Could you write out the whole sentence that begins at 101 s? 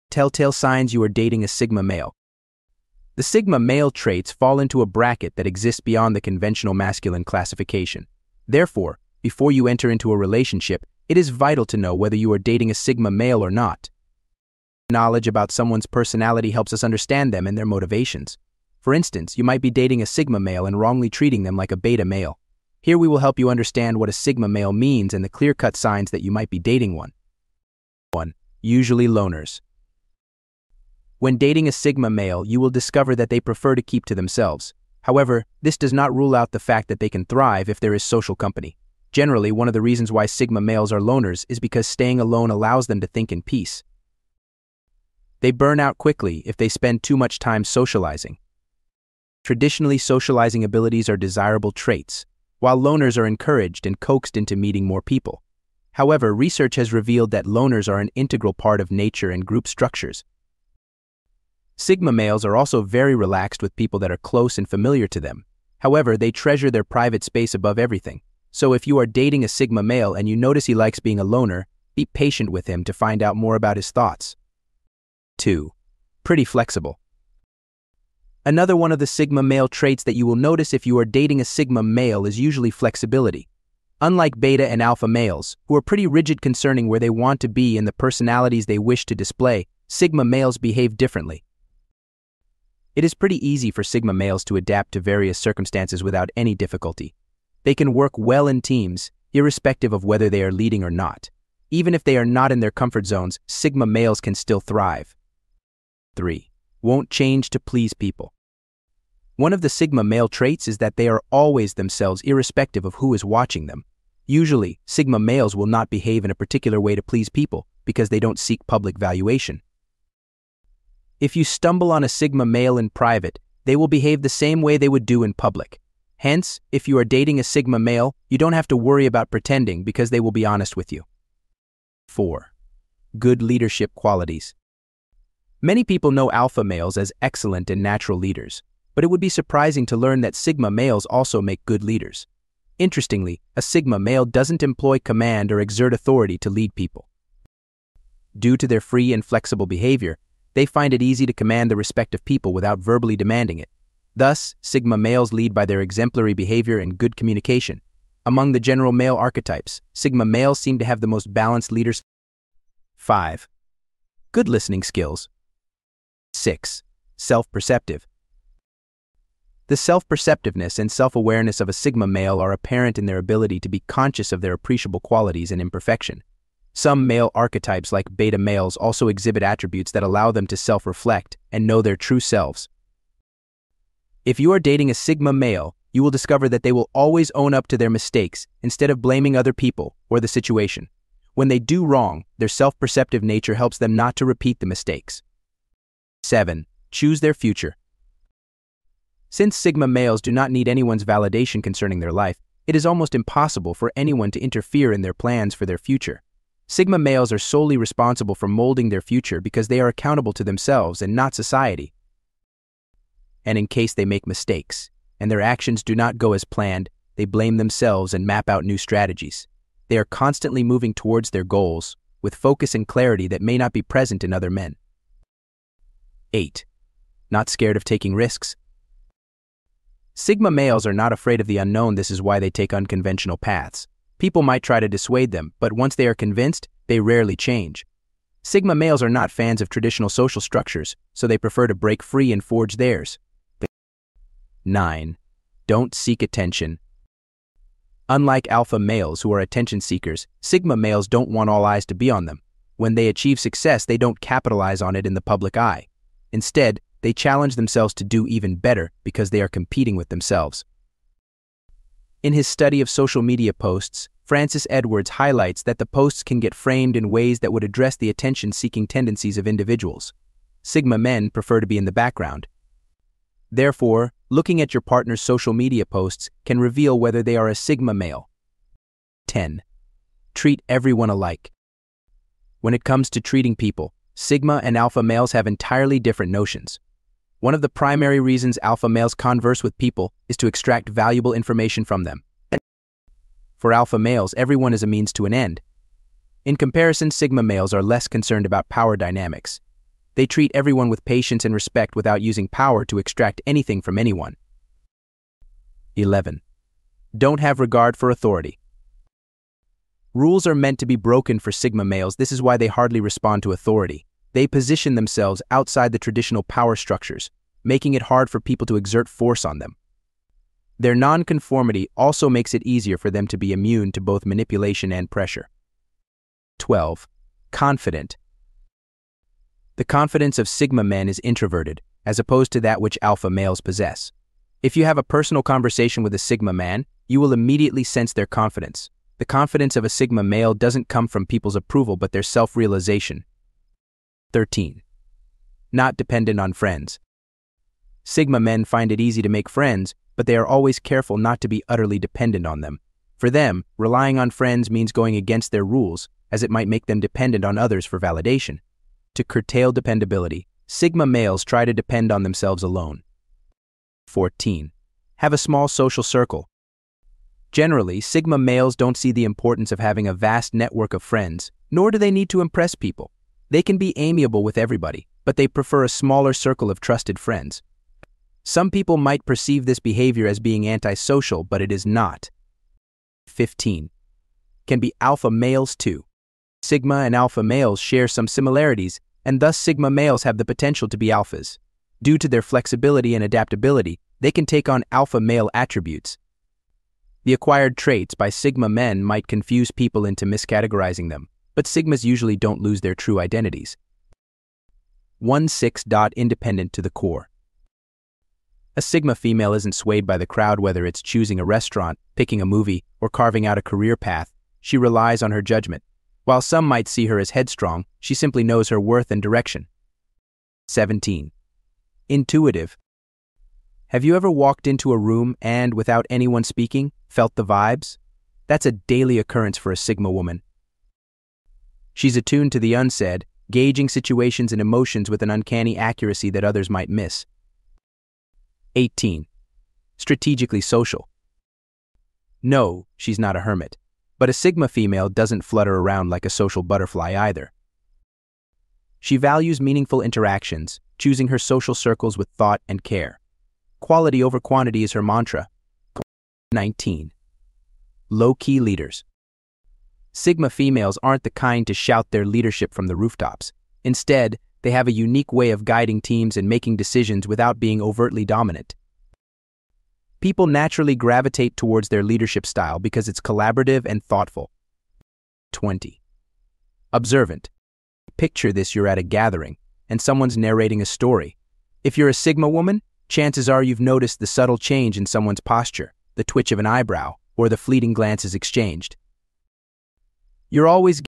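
Even if they are not in their comfort zones, Sigma males can still thrive.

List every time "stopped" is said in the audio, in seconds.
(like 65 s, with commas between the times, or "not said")
not said.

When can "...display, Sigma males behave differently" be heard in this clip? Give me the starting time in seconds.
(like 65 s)
89 s.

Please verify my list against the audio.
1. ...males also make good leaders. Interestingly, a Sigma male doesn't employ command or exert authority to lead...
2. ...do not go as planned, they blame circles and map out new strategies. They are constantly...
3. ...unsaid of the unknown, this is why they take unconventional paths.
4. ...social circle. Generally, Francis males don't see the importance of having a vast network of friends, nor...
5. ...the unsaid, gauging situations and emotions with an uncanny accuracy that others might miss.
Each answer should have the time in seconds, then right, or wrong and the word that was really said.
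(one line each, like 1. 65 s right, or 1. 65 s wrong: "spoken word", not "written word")
1. 140 s right
2. 215 s wrong: "themselves", not "circles"
3. 231 s wrong: "afraid", not "unsaid"
4. 365 s wrong: "Sigma", not "Francis"
5. 432 s right.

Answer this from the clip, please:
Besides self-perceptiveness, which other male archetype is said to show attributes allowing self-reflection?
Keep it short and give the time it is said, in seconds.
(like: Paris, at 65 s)
beta males, at 178 s.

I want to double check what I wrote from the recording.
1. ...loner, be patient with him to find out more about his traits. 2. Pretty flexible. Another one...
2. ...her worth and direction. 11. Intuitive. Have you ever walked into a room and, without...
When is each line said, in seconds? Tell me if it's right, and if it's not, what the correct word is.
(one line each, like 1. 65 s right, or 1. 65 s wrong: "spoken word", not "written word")
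1. 71 s wrong: "thoughts", not "traits"
2. 418 s wrong: "17", not "11".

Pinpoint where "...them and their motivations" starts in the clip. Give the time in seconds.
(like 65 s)
17 s.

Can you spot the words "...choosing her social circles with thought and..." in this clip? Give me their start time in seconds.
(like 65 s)
450 s.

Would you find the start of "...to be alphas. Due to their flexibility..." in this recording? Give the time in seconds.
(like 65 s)
390 s.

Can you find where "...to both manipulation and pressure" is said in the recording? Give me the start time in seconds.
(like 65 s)
323 s.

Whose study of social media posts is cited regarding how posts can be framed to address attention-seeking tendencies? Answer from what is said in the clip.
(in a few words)
Francis Edwards.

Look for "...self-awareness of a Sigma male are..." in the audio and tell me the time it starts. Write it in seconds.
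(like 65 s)
170 s.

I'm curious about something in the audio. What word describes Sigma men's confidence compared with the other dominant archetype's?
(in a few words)
introverted.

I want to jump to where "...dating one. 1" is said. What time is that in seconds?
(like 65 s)
26 s.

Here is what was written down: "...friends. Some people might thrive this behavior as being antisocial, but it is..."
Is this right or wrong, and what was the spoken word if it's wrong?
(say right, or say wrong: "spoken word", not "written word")
wrong: "perceive", not "thrive".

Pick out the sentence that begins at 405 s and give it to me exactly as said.
1-6 dot independent to the core.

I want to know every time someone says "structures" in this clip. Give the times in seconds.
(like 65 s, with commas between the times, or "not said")
59 s, 240 s, 316 s.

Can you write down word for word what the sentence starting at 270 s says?
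Sigma men prefer to be in the background.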